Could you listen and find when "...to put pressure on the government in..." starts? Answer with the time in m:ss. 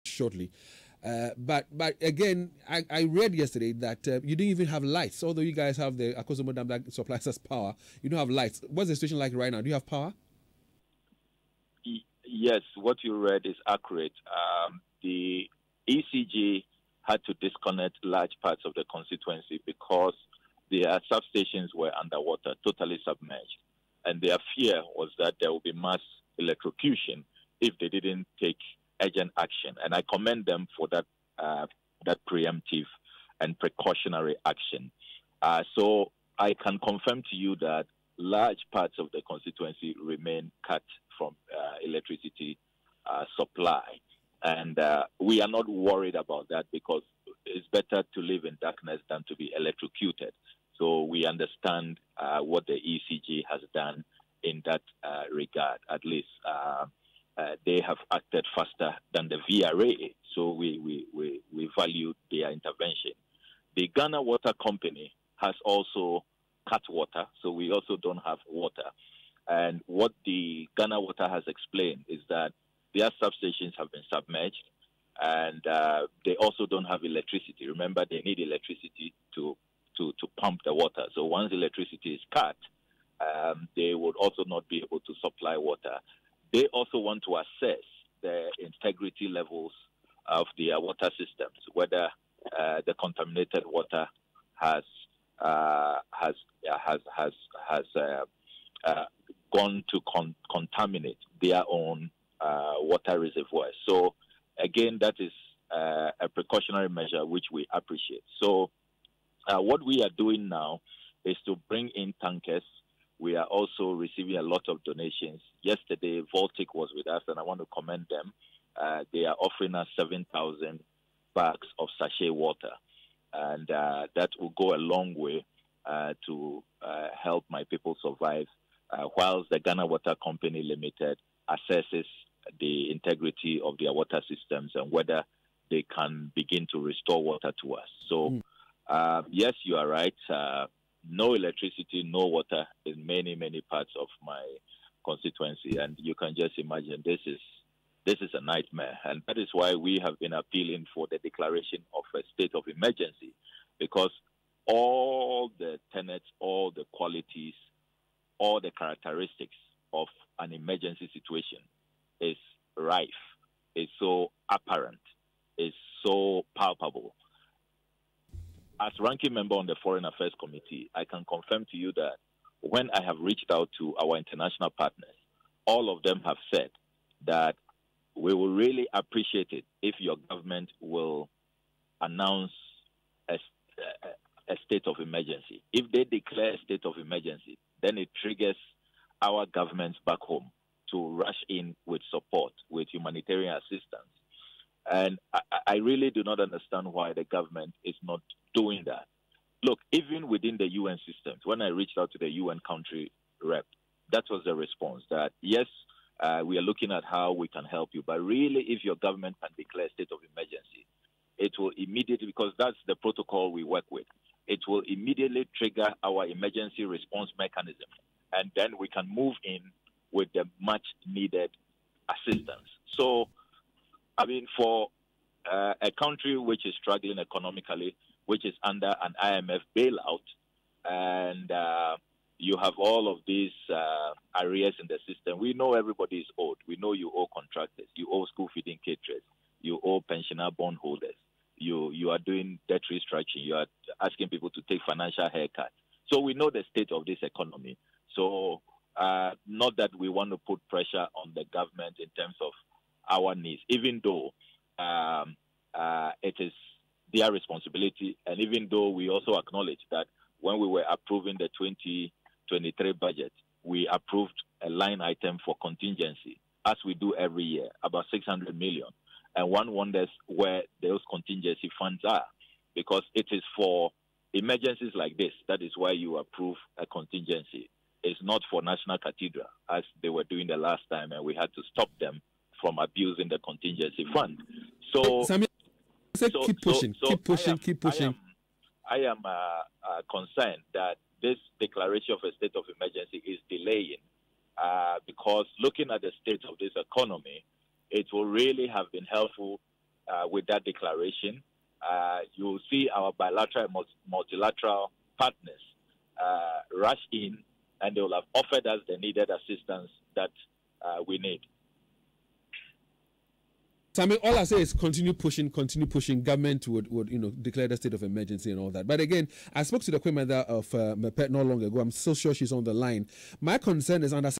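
4:10.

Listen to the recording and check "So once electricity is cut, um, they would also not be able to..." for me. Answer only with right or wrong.
right.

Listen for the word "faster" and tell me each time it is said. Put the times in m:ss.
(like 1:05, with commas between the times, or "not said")
0:58.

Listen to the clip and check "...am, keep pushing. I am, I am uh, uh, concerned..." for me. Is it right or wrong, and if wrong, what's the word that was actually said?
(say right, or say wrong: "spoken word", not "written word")
right.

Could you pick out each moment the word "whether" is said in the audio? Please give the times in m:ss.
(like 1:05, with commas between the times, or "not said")
1:31, 2:14.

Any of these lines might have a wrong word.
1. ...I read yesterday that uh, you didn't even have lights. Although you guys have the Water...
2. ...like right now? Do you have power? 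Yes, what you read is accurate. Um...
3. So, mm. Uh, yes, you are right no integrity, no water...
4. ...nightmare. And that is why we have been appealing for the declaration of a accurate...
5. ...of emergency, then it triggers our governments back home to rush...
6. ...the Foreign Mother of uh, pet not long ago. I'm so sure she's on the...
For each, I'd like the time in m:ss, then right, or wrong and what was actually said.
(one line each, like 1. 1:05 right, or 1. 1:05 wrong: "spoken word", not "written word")
1. 0:02 wrong: "Akosombo", not "Water"
2. 0:09 right
3. 2:18 wrong: "electricity", not "integrity"
4. 2:28 wrong: "state", not "accurate"
5. 3:06 right
6. 5:19 wrong: "Queen", not "Foreign".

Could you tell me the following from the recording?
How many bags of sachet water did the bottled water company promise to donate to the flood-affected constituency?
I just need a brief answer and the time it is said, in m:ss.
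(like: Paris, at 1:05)
7,000, at 1:59.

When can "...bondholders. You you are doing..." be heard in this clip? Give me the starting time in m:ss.
4:00.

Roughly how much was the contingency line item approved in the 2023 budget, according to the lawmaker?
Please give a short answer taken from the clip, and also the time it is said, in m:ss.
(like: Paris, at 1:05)
600 million, at 4:28.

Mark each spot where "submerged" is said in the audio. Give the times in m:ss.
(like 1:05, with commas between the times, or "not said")
0:23, 1:14.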